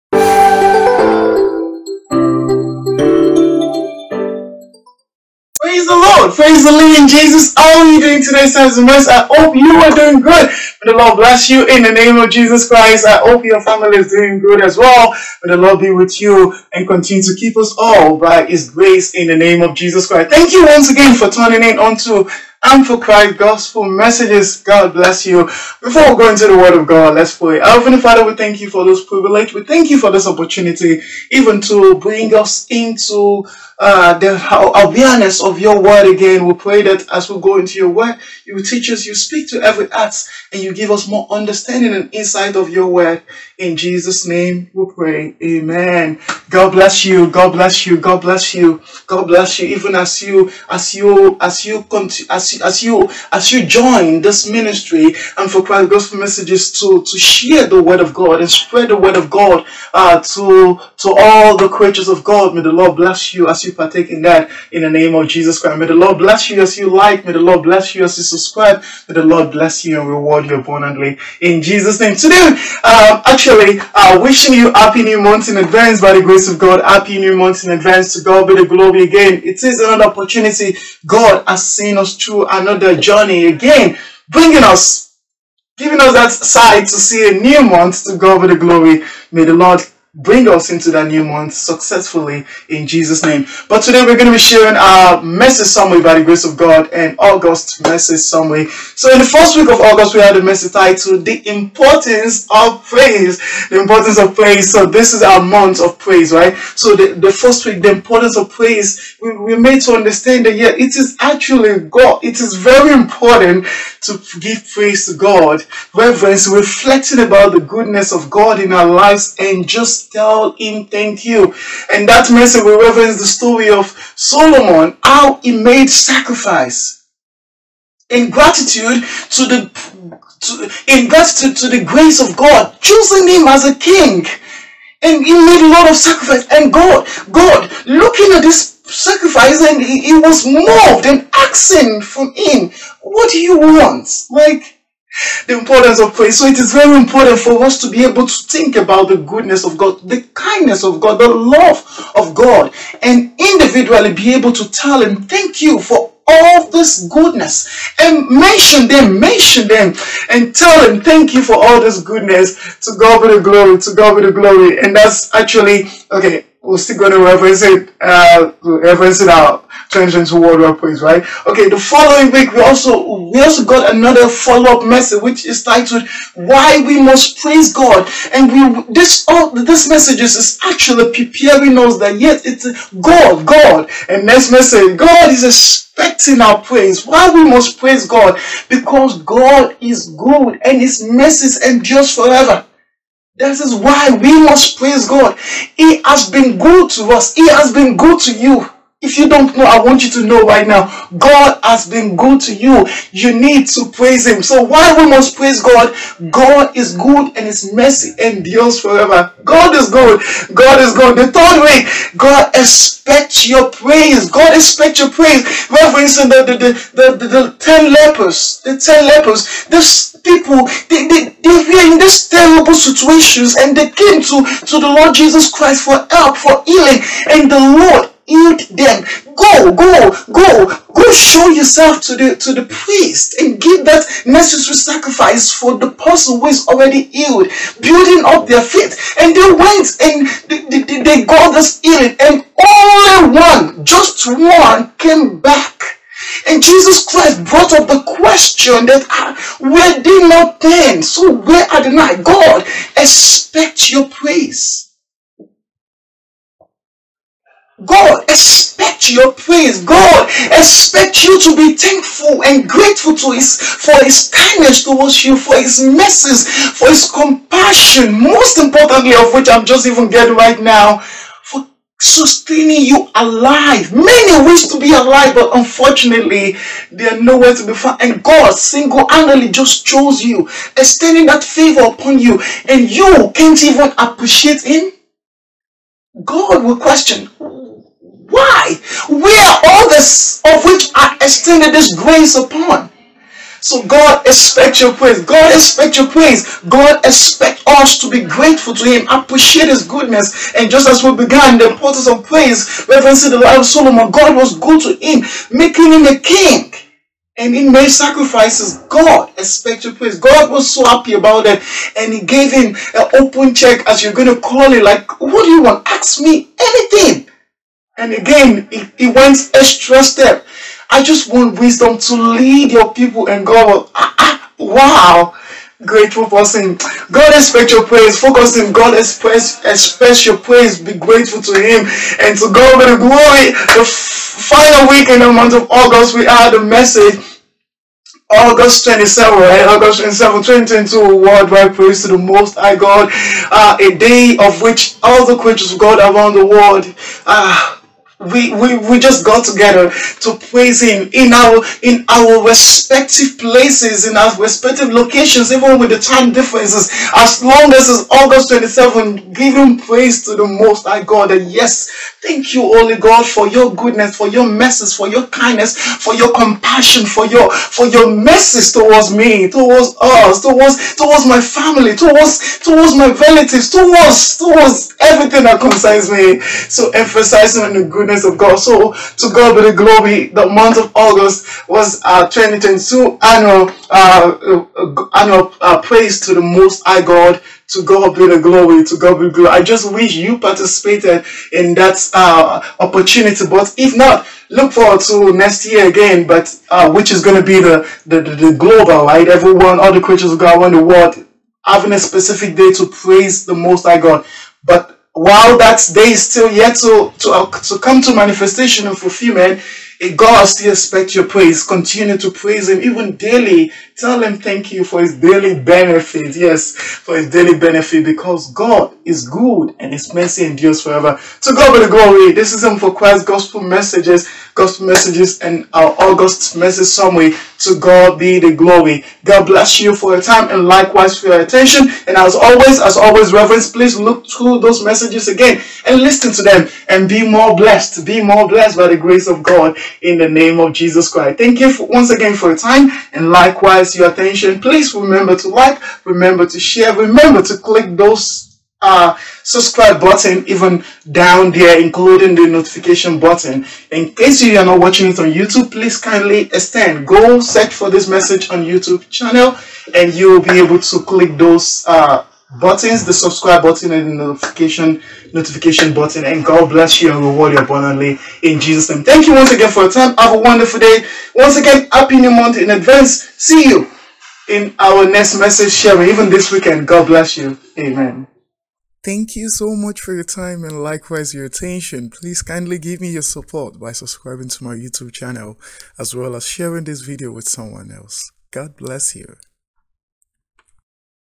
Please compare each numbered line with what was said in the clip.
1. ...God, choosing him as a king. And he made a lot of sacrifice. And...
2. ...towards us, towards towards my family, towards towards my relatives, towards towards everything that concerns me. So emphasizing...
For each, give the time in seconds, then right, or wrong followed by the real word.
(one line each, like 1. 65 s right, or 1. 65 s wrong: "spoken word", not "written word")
1. 132 s right
2. 369 s right.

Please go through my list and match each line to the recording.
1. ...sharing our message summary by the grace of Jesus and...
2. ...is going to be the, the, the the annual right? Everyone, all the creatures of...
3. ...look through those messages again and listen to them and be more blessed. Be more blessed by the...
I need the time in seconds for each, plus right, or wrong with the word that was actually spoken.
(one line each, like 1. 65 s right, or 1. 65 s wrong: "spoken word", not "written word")
1. 94 s wrong: "God", not "Jesus"
2. 397 s wrong: "global", not "annual"
3. 433 s right.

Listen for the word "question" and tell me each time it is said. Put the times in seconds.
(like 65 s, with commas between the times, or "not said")
248 s, 286 s.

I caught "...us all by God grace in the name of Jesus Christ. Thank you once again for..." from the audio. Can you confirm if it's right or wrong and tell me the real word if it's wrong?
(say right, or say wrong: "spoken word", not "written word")
wrong: "His", not "God".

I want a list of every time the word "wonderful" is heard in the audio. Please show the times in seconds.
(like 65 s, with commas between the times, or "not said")
470 s.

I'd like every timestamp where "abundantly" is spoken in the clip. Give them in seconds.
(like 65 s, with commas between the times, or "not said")
70 s, 467 s.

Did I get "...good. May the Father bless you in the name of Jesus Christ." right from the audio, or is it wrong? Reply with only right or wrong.
wrong.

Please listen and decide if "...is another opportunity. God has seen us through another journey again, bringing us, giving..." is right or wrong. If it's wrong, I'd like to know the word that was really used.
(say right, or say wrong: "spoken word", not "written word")
right.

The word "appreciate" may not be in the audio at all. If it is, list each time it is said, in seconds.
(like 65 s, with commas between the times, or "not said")
283 s, 299 s.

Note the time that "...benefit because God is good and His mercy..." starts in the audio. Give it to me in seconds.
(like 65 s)
417 s.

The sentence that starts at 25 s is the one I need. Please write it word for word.
Before we go into the word of God, let's pray.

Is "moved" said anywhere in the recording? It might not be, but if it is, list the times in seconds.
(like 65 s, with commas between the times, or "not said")
140 s.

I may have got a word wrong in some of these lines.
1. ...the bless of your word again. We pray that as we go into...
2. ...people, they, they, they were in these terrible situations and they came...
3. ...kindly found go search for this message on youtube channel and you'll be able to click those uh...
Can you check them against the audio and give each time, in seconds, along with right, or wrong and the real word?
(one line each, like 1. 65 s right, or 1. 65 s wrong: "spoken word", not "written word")
1. 34 s wrong: "awareness", not "bless"
2. 220 s right
3. 455 s wrong: "extend", not "found".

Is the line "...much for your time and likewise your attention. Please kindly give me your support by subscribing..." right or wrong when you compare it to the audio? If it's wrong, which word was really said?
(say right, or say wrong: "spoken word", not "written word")
right.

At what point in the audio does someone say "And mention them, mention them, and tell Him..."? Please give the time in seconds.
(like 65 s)
157 s.